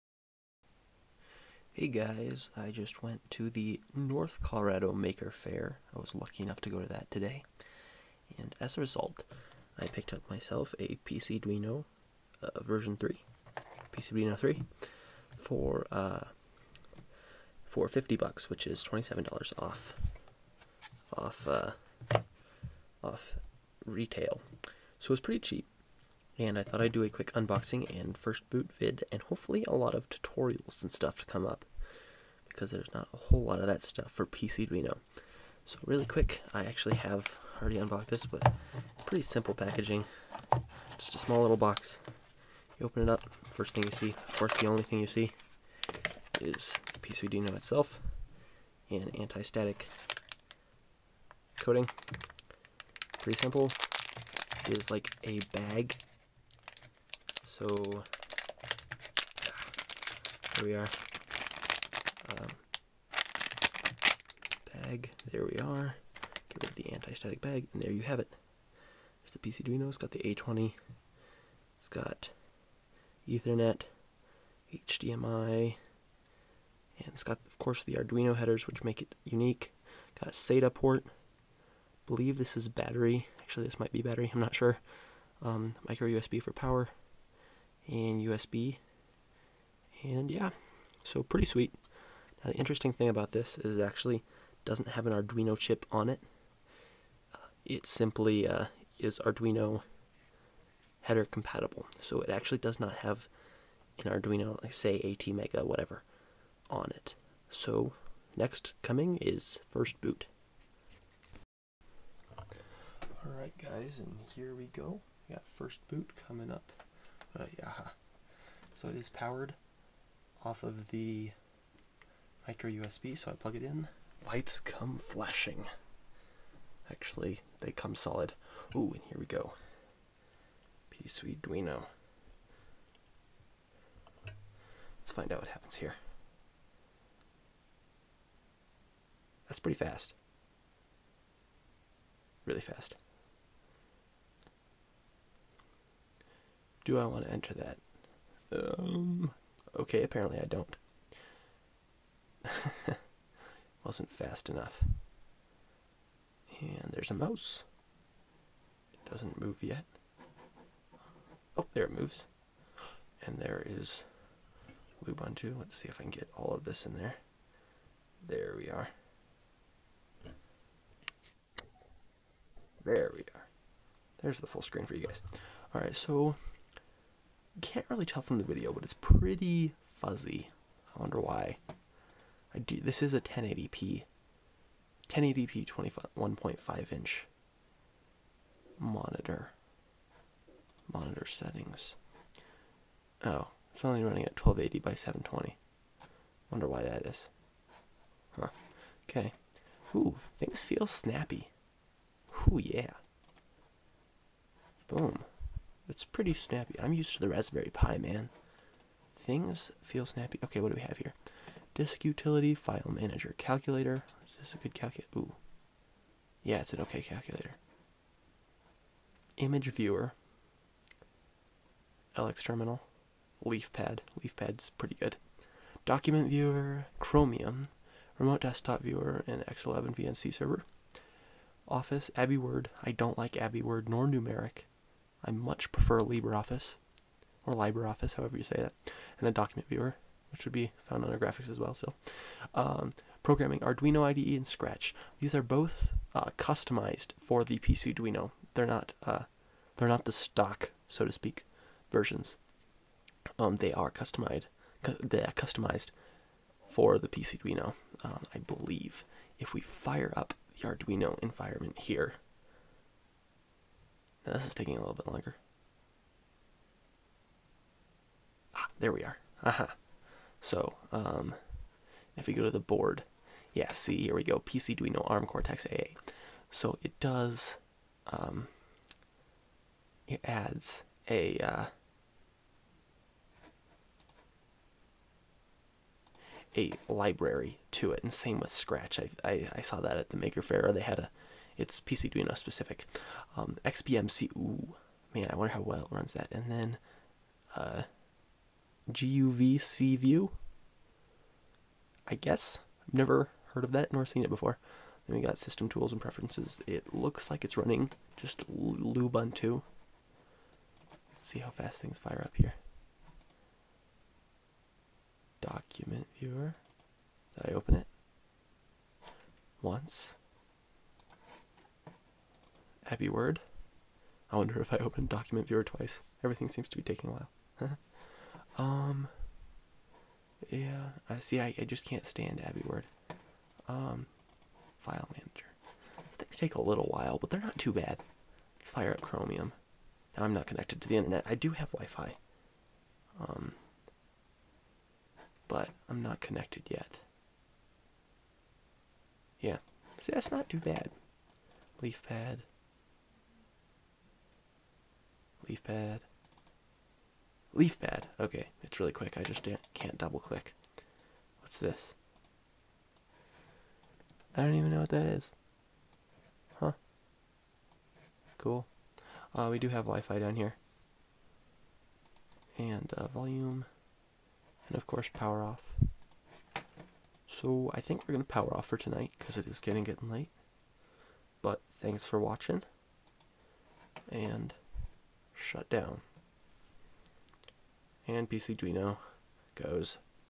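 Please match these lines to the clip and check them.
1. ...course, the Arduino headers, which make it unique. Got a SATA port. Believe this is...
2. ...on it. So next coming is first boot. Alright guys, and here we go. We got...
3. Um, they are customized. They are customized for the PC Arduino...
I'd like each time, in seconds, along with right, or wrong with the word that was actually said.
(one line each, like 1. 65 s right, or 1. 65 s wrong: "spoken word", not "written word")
1. 77 s right
2. 106 s right
3. 253 s right.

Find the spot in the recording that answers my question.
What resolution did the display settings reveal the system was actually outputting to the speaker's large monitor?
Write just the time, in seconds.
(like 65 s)
194 s.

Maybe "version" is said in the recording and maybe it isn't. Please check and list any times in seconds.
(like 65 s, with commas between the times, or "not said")
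12 s, 251 s.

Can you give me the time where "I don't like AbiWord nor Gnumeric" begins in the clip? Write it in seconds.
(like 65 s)
232 s.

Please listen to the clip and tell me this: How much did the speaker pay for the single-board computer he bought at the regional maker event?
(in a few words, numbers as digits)
$50.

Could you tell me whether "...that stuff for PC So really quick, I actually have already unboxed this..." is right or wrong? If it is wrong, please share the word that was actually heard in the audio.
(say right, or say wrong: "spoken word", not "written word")
right.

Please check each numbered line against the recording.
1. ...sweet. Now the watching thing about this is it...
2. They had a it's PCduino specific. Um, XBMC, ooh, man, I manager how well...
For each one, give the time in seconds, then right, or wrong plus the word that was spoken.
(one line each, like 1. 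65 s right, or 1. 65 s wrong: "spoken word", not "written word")
1. 91 s wrong: "interesting", not "watching"
2. 290 s wrong: "wonder", not "manager".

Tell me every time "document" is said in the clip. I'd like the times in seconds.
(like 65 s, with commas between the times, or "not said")
225 s, 239 s, 315 s, 325 s.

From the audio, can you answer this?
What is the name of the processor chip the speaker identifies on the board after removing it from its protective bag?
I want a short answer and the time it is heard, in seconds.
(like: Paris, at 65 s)
A20, at 70 s.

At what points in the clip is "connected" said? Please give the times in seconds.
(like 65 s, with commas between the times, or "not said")
340 s, 346 s.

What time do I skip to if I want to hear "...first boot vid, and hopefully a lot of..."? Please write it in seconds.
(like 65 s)
28 s.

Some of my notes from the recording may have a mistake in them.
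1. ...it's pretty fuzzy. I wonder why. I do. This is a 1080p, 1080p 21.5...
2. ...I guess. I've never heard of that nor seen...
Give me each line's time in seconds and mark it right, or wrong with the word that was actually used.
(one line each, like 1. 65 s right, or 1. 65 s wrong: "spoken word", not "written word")
1. 178 s right
2. 302 s right.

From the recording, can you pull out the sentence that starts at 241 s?
So, um, programming Arduino IDE and Scratch.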